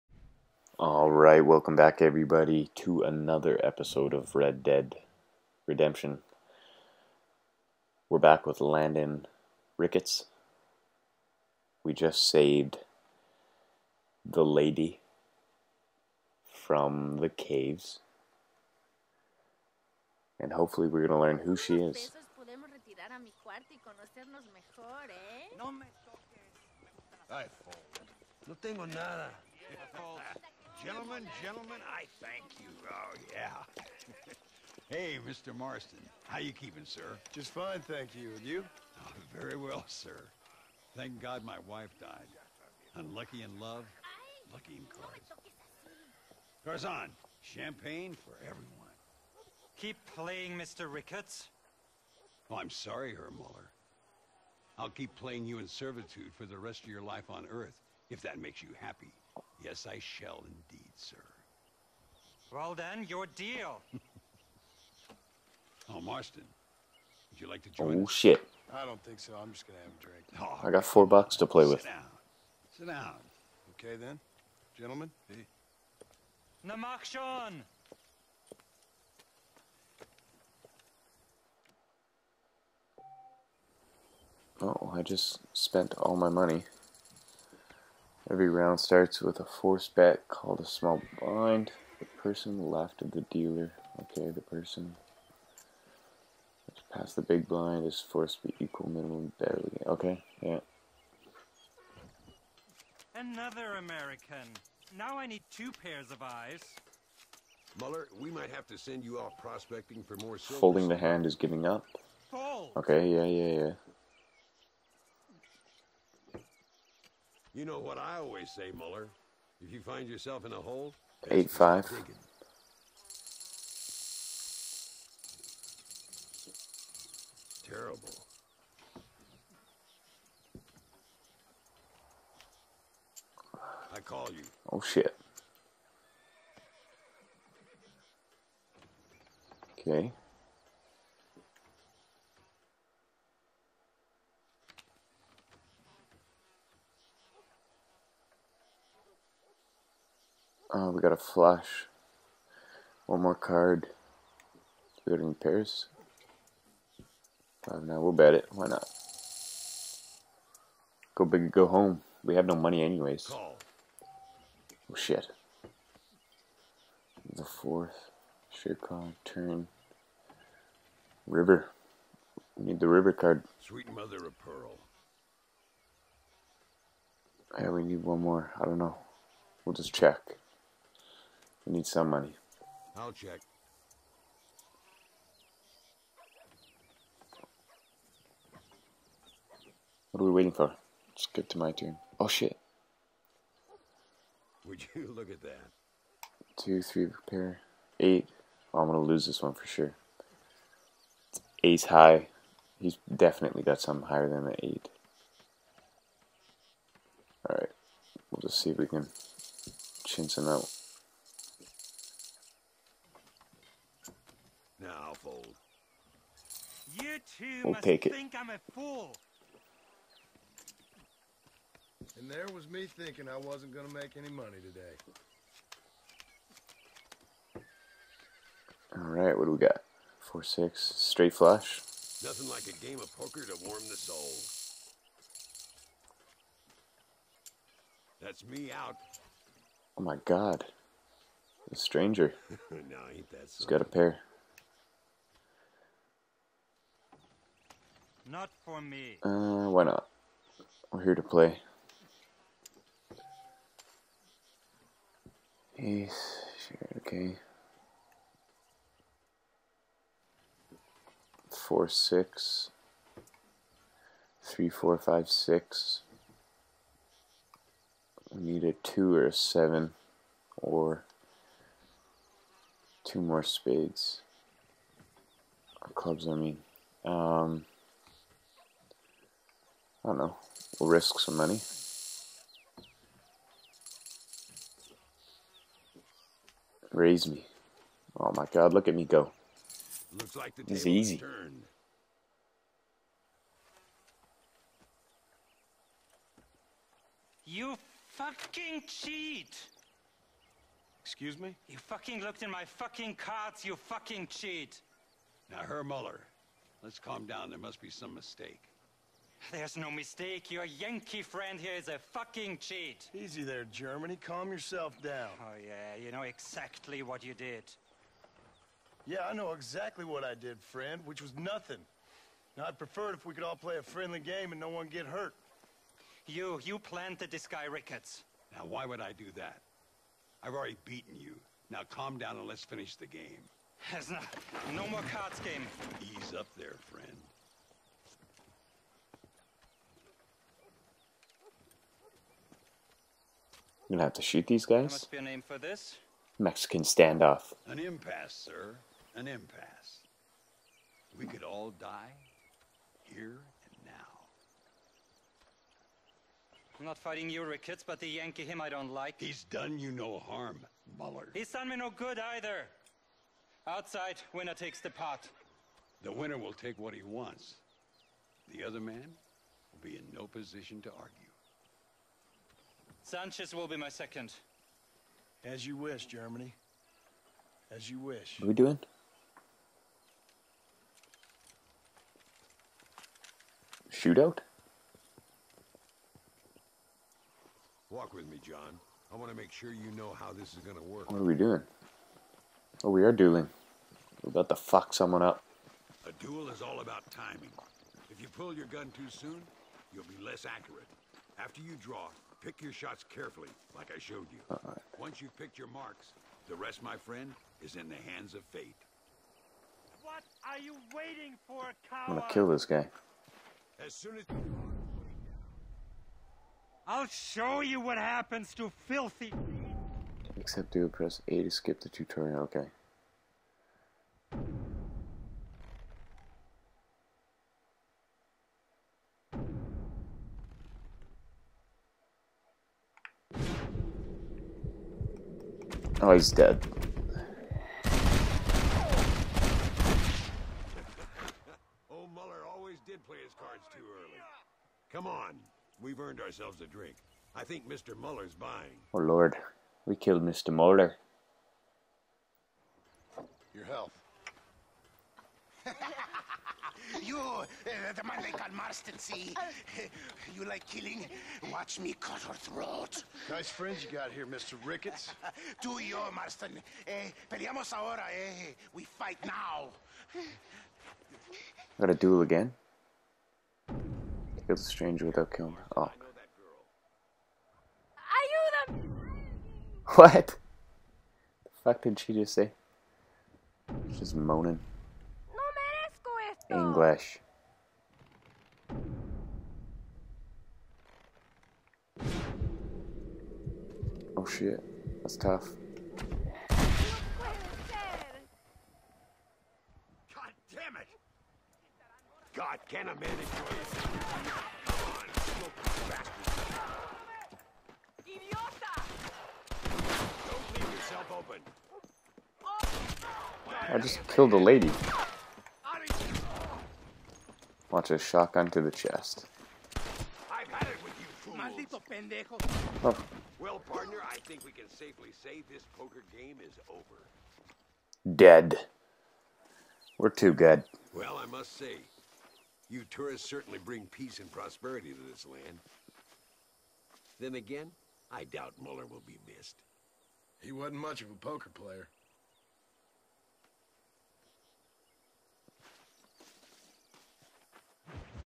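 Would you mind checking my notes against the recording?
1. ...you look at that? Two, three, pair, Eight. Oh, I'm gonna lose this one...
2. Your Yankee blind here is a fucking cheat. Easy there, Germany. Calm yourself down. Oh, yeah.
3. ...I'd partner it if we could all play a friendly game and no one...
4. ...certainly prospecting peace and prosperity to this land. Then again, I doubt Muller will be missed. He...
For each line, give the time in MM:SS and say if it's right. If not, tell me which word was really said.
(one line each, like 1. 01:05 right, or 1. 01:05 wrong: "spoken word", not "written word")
1. 03:14 right
2. 05:10 wrong: "friend", not "blind"
3. 05:22 wrong: "prefer", not "partner"
4. 08:53 wrong: "bring", not "prospecting".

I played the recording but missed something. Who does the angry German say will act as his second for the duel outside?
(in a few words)
Sanchez.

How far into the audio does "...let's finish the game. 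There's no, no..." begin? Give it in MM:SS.
05:32.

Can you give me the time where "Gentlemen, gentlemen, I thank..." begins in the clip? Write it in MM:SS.
00:30.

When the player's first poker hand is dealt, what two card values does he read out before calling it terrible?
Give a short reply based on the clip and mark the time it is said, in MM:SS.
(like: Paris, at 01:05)
eight five, at 02:01.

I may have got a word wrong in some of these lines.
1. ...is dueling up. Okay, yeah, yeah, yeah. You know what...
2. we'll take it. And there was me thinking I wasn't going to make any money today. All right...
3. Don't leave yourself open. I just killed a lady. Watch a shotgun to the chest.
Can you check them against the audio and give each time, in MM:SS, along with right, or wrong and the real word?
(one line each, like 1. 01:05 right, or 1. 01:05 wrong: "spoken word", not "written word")
1. 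01:51 wrong: "giving", not "dueling"
2. 03:37 right
3. 08:30 right.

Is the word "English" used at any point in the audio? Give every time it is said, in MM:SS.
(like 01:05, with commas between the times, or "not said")
08:06.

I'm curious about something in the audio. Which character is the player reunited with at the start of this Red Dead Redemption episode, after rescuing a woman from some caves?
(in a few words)
Landon Ricketts.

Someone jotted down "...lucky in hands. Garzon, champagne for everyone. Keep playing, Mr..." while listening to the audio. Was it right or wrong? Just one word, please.
wrong.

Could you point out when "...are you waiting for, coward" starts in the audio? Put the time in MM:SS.
06:50.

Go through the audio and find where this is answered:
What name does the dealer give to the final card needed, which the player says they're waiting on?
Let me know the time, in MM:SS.
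02:52.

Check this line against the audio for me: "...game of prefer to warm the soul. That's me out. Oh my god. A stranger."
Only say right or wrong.
wrong.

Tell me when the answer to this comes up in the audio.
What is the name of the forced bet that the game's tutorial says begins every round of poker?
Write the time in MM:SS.
01:30.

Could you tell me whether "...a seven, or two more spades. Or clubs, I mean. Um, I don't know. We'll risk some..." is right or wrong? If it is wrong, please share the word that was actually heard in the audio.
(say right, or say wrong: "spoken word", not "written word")
right.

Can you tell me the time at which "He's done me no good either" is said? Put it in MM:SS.
06:01.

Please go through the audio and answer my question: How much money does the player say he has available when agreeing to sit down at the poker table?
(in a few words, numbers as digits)
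4 bucks.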